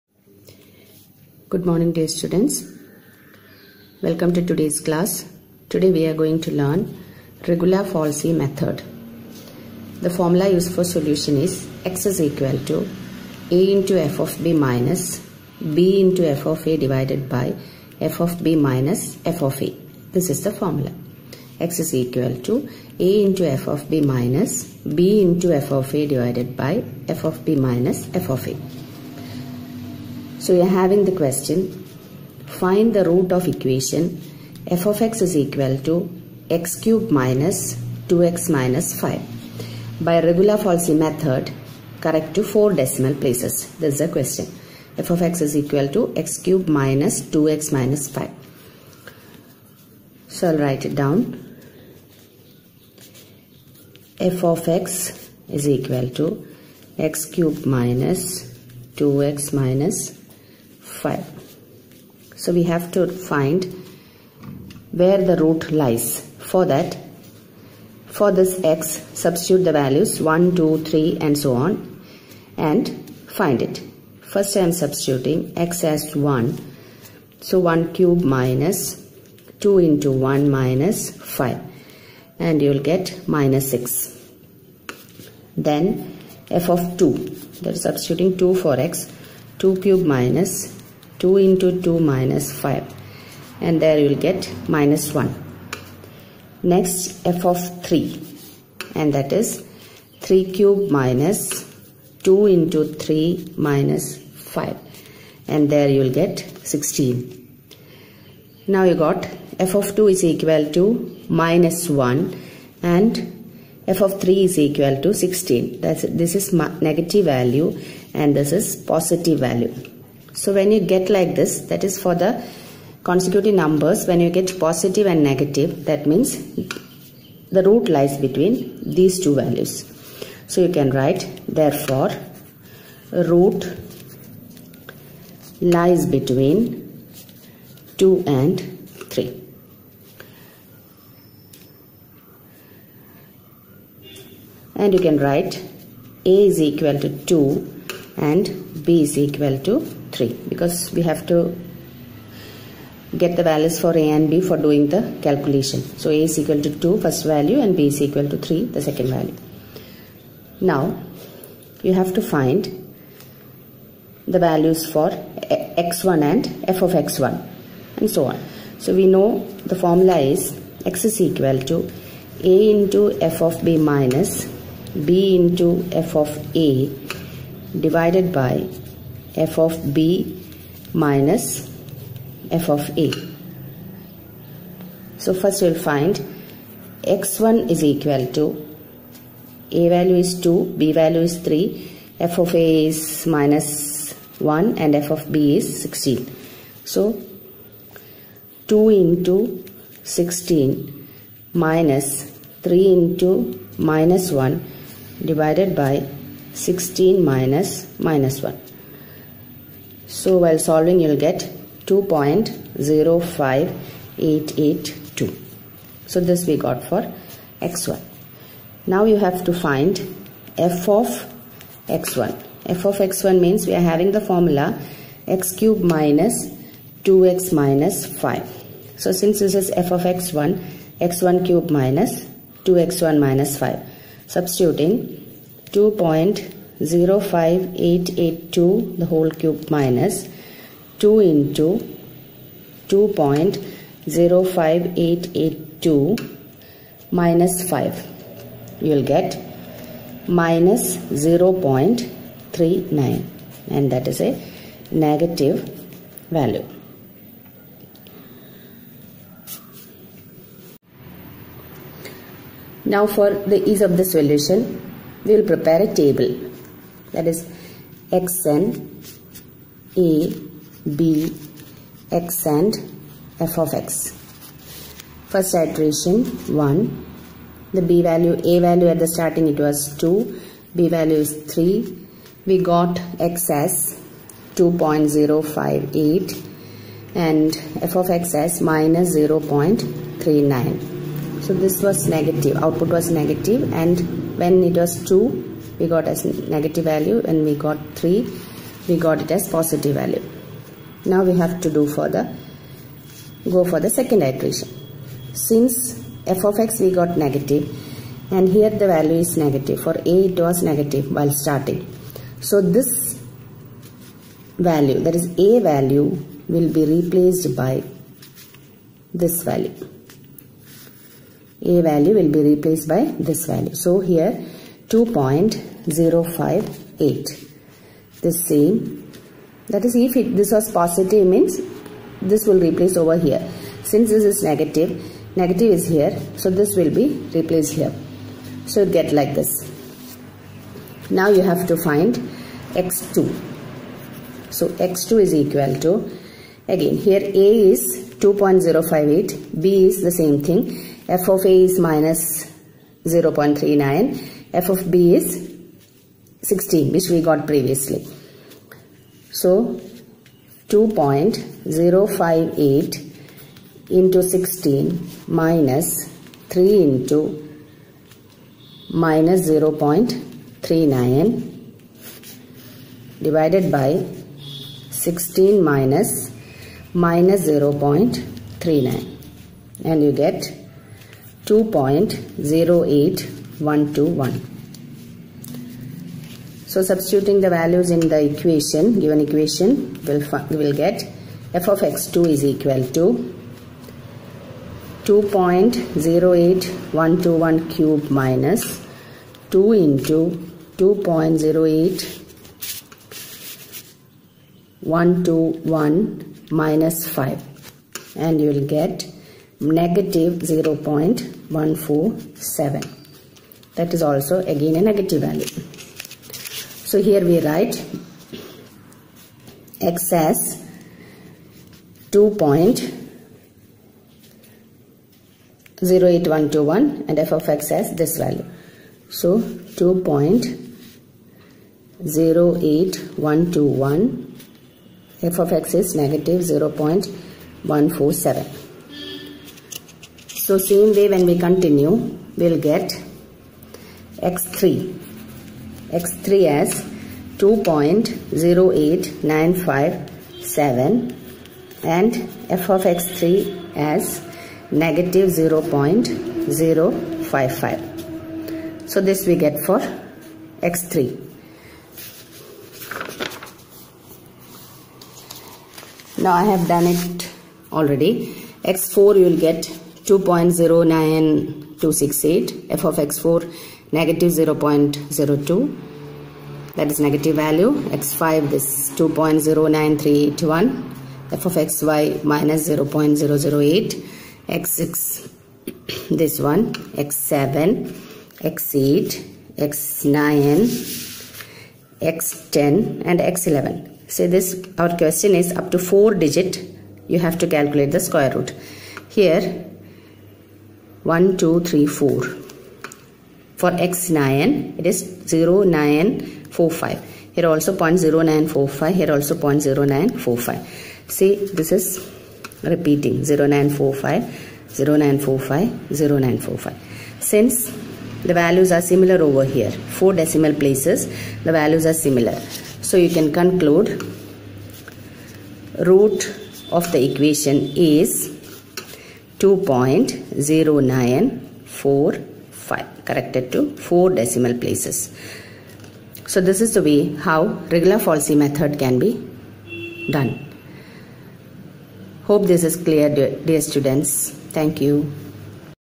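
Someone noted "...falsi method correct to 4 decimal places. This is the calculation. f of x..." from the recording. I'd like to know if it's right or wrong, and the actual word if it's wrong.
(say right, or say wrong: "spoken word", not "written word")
wrong: "question", not "calculation".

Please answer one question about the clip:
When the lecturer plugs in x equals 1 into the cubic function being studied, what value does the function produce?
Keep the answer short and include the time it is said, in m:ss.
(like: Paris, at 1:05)
-6, at 1:23.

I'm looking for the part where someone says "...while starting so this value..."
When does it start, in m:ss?
5:11.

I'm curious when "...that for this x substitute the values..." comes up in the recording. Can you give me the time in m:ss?
1:06.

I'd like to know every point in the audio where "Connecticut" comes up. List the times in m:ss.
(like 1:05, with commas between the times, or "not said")
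not said.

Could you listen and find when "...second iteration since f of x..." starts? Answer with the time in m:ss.
5:03.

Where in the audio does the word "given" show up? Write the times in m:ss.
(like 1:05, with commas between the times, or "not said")
6:28.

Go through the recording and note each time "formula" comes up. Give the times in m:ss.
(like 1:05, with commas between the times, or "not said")
0:10, 0:20, 2:49, 3:44.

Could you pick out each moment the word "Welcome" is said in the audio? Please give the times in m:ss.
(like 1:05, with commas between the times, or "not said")
0:04.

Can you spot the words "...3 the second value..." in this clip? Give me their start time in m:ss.
2:38.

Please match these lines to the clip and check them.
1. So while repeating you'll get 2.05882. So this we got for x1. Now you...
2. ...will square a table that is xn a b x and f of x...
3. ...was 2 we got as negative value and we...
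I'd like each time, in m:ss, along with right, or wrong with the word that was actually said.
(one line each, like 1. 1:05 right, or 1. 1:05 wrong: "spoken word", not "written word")
1. 3:30 wrong: "solving", not "repeating"
2. 4:25 wrong: "prepare", not "square"
3. 4:54 right.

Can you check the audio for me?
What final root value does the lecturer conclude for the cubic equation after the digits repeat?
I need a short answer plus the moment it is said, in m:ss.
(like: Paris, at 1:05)
2.0945, at 8:49.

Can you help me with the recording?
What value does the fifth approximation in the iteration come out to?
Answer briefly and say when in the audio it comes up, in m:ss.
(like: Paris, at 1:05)
2.09381, at 7:58.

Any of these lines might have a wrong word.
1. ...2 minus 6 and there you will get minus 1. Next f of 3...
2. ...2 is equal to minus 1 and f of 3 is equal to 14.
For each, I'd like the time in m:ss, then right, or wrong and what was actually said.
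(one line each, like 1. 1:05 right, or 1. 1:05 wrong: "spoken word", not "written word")
1. 1:31 wrong: "5", not "6"
2. 1:49 wrong: "16", not "14".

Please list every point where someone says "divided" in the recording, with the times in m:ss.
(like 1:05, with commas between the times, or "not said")
0:16, 0:26, 2:57, 3:25.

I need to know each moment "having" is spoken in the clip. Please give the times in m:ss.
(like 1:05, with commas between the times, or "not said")
0:30, 3:43.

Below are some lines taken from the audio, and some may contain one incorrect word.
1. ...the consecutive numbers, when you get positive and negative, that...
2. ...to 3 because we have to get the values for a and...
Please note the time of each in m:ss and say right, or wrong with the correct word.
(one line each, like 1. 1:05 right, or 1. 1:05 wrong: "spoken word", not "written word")
1. 2:02 right
2. 2:29 right.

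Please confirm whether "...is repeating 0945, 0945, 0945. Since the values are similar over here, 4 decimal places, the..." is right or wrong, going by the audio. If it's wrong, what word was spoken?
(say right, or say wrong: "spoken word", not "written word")
right.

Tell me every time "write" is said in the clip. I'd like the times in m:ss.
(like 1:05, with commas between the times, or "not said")
0:50, 2:10, 2:25, 6:57.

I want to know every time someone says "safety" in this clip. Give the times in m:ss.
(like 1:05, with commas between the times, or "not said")
not said.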